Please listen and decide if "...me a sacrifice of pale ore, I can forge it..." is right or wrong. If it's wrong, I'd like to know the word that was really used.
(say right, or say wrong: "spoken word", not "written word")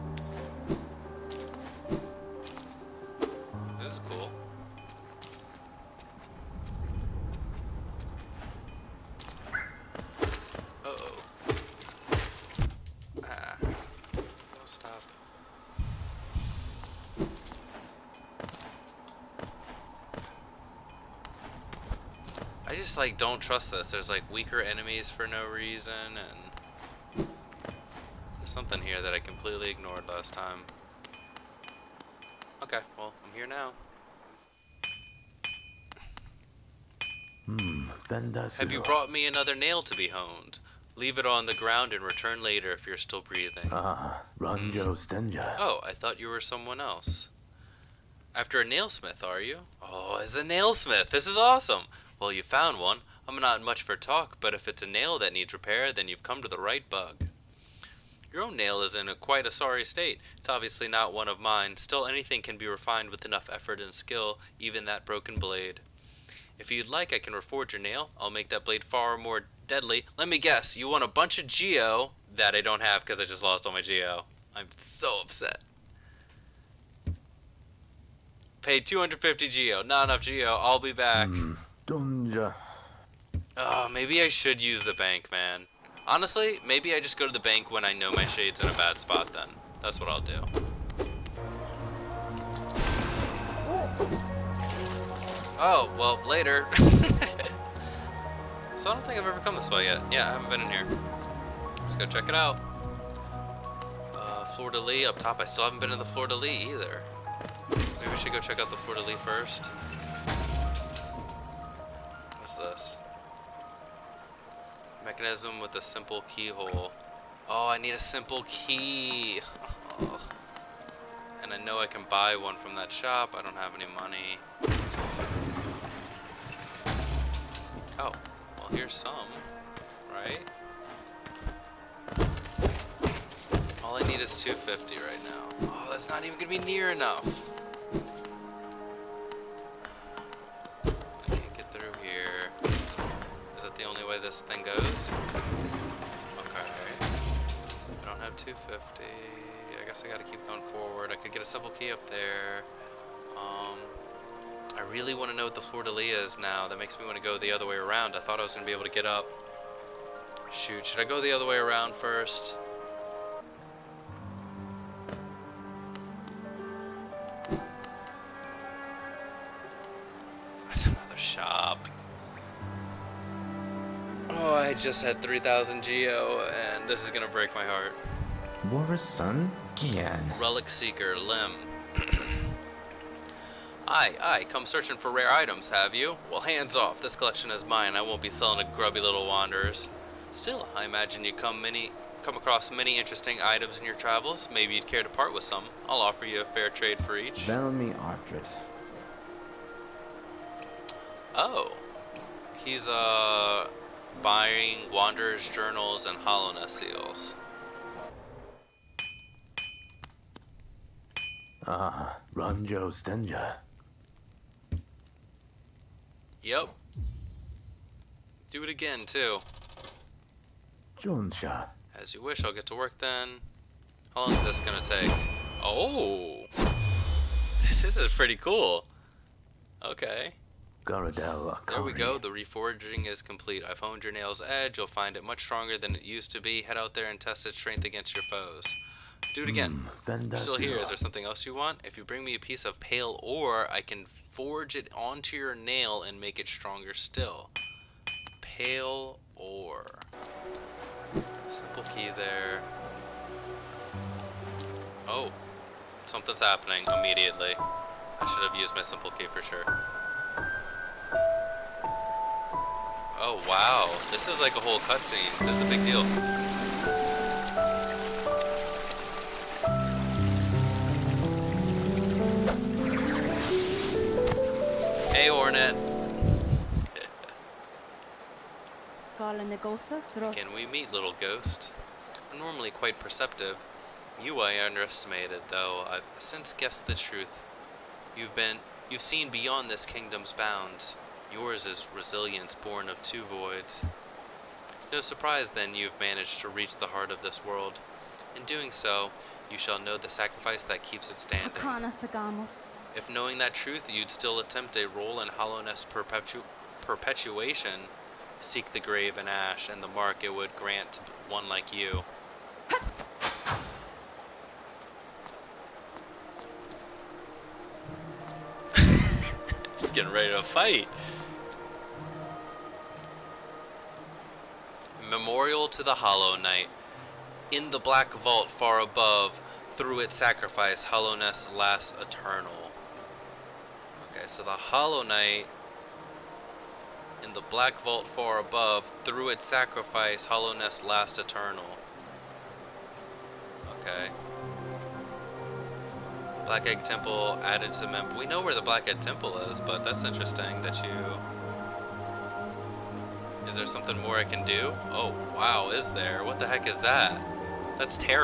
wrong: "piece", not "sacrifice".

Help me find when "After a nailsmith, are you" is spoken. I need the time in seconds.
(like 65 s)
48 s.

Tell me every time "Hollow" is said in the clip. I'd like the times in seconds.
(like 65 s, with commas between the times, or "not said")
325 s, 334 s.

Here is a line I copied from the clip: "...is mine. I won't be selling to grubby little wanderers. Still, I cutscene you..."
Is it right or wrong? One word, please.
wrong.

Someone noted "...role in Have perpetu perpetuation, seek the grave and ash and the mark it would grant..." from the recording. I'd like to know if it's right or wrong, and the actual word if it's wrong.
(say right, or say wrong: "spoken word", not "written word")
wrong: "Hallownest", not "Have".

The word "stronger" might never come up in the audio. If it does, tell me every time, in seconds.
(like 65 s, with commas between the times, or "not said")
235 s, 246 s.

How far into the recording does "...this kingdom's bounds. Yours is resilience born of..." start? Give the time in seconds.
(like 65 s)
289 s.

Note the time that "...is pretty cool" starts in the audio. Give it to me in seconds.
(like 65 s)
227 s.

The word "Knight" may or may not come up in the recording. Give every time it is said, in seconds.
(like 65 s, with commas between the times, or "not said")
326 s, 335 s.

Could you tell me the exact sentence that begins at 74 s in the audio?
I'm so upset pay 250 geo not enough geo i'll be back mm.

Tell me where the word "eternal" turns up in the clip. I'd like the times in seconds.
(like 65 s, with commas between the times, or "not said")
331 s, 341 s.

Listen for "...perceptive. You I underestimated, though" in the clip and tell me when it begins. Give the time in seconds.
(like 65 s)
282 s.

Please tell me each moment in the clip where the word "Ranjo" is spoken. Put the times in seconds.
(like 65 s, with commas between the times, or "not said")
44 s, 212 s.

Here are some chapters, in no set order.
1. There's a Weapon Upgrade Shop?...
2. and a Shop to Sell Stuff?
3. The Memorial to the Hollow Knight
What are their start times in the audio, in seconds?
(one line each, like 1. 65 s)
1. 38 s
2. 166 s
3. 254 s.